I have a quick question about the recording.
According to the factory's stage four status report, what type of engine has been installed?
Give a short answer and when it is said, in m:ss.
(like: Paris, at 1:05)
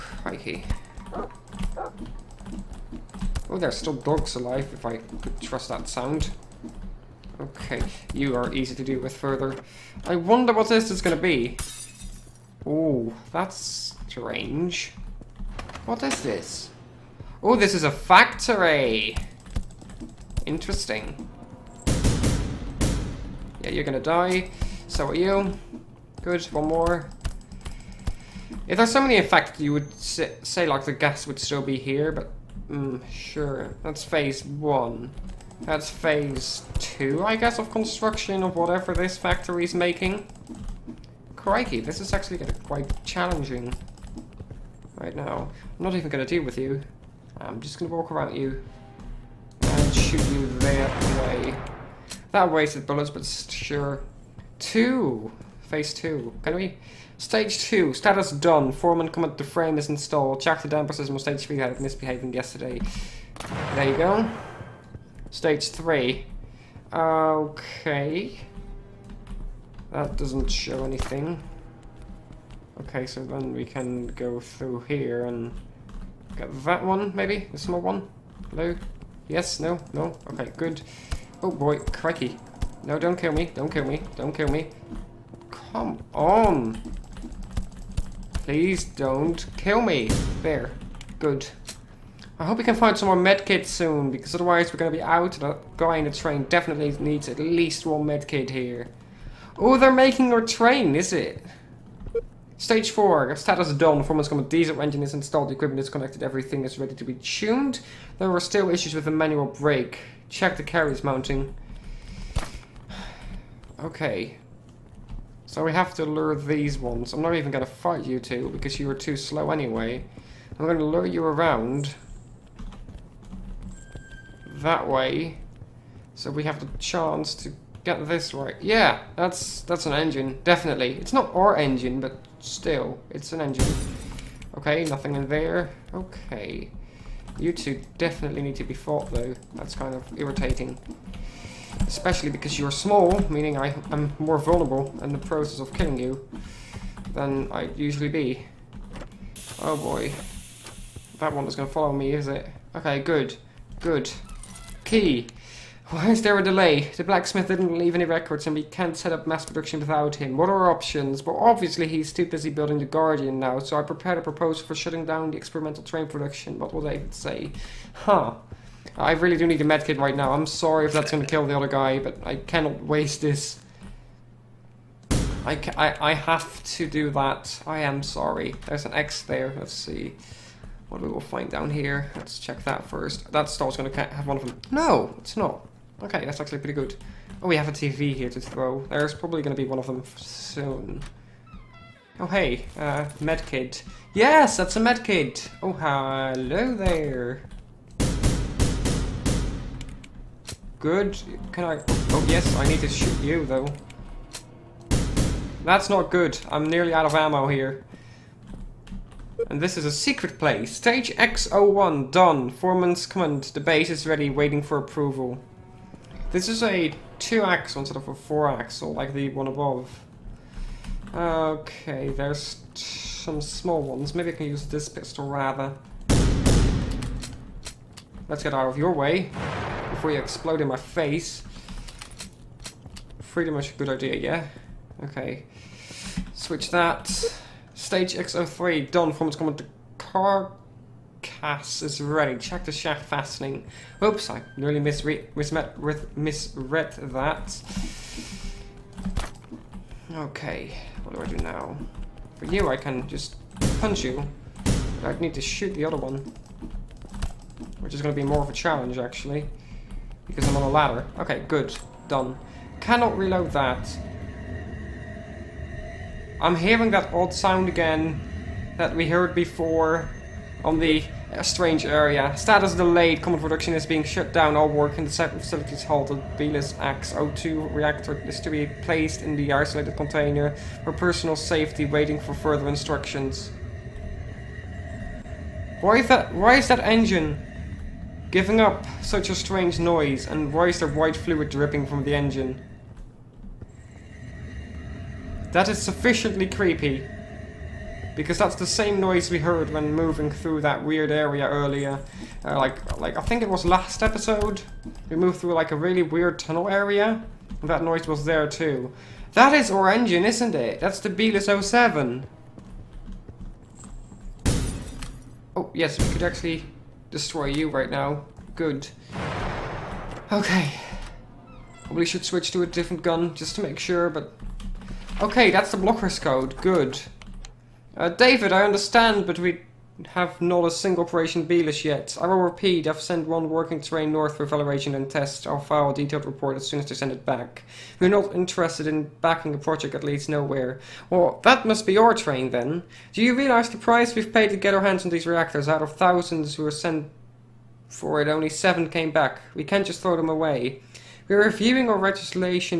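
diesel engine, at 1:44.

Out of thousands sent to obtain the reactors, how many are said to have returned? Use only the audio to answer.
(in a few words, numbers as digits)
7.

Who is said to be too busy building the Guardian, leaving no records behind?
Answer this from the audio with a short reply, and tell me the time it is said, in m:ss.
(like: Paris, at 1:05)
The blacksmith, at 2:37.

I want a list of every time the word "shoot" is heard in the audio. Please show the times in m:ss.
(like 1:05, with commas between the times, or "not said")
0:49, 3:22, 4:15.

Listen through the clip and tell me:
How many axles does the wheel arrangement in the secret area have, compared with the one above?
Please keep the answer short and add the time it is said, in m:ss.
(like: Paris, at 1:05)
two-axle, at 3:37.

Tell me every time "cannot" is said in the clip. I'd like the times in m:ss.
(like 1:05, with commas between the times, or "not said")
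2:52, 4:22.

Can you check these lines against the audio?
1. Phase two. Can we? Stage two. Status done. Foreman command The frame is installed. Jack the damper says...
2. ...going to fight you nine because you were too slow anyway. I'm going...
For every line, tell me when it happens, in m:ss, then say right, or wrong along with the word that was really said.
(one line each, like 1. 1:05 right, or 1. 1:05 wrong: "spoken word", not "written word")
1. 0:55 right
2. 1:57 wrong: "two", not "nine".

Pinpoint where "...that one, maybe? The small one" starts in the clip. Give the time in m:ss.
1:16.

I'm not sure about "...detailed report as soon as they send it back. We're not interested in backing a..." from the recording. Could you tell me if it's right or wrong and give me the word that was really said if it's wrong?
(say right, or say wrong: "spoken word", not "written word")
right.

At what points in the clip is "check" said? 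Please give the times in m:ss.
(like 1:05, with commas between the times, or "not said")
1:50, 3:02, 4:02.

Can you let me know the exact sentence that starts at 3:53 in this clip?
Freedom is a good idea, yeah?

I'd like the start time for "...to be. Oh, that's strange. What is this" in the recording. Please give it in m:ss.
0:11.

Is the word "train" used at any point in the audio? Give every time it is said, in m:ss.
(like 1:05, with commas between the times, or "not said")
1:36, 1:40, 2:45, 5:33, 5:42.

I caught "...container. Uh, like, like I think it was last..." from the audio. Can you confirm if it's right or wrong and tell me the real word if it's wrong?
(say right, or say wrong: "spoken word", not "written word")
wrong: "earlier", not "container".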